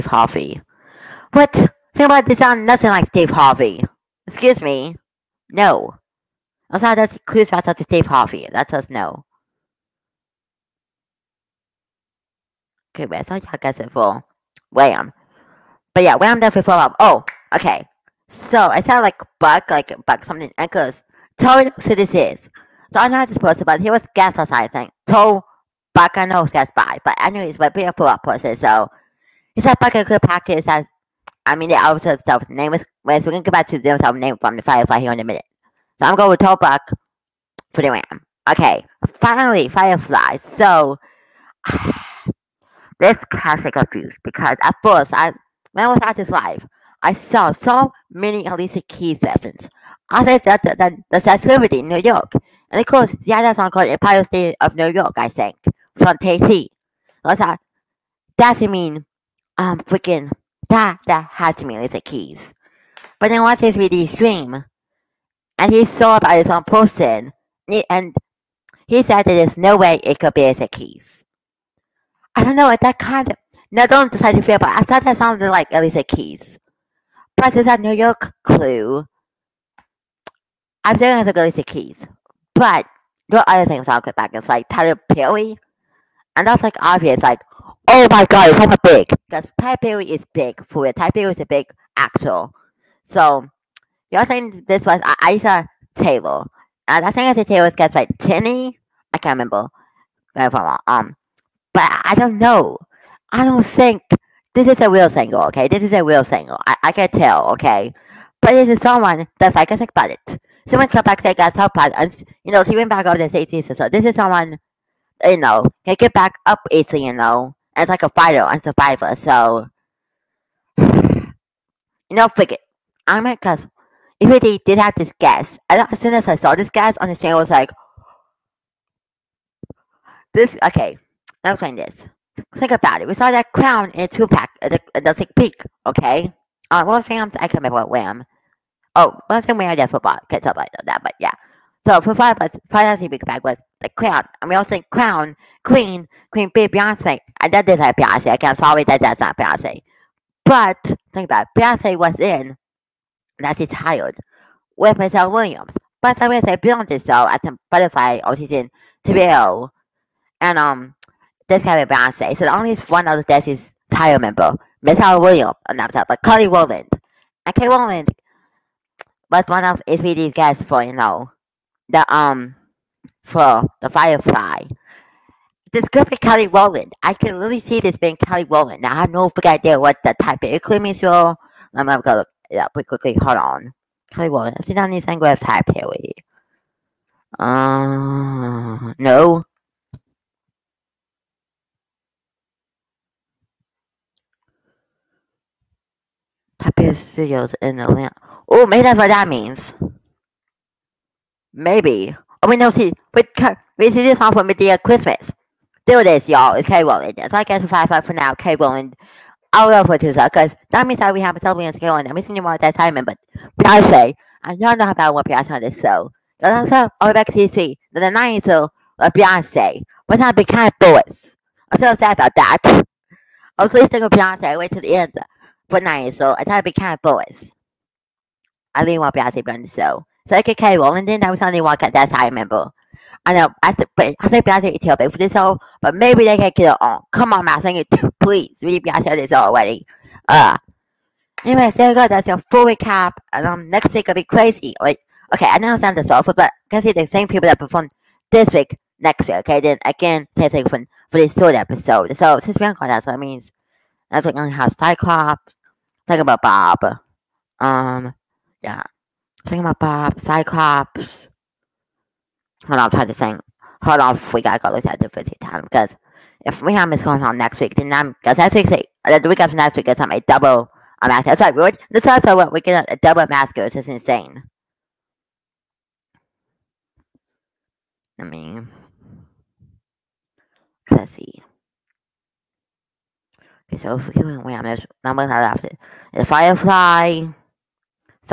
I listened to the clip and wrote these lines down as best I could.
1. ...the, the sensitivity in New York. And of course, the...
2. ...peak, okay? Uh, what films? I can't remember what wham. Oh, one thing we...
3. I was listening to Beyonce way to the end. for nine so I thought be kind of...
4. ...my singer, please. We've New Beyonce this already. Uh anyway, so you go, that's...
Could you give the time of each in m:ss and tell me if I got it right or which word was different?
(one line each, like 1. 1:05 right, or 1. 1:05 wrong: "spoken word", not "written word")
1. 0:50 right
2. 2:15 right
3. 3:43 right
4. 3:57 wrong: "Really", not "New".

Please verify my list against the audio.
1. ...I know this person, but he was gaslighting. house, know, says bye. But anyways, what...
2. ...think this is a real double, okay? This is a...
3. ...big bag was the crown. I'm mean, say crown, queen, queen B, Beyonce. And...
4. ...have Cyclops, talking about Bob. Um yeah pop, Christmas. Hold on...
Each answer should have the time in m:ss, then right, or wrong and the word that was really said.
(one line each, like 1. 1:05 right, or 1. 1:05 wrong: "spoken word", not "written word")
1. 0:22 right
2. 1:43 wrong: "single", not "double"
3. 2:23 right
4. 4:14 wrong: "Cyclops", not "Christmas".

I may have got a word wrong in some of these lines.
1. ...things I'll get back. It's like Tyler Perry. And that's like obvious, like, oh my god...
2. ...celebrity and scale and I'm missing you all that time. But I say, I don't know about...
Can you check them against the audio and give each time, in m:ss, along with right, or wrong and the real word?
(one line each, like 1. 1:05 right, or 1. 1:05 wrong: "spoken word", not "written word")
1. 1:23 right
2. 3:31 right.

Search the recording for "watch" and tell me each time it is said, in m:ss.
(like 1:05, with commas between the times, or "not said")
1:03.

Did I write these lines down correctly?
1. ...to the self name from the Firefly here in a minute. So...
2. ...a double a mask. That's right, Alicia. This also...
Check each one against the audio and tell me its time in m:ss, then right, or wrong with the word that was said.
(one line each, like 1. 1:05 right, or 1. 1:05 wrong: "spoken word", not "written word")
1. 0:33 right
2. 4:30 wrong: "George", not "Alicia".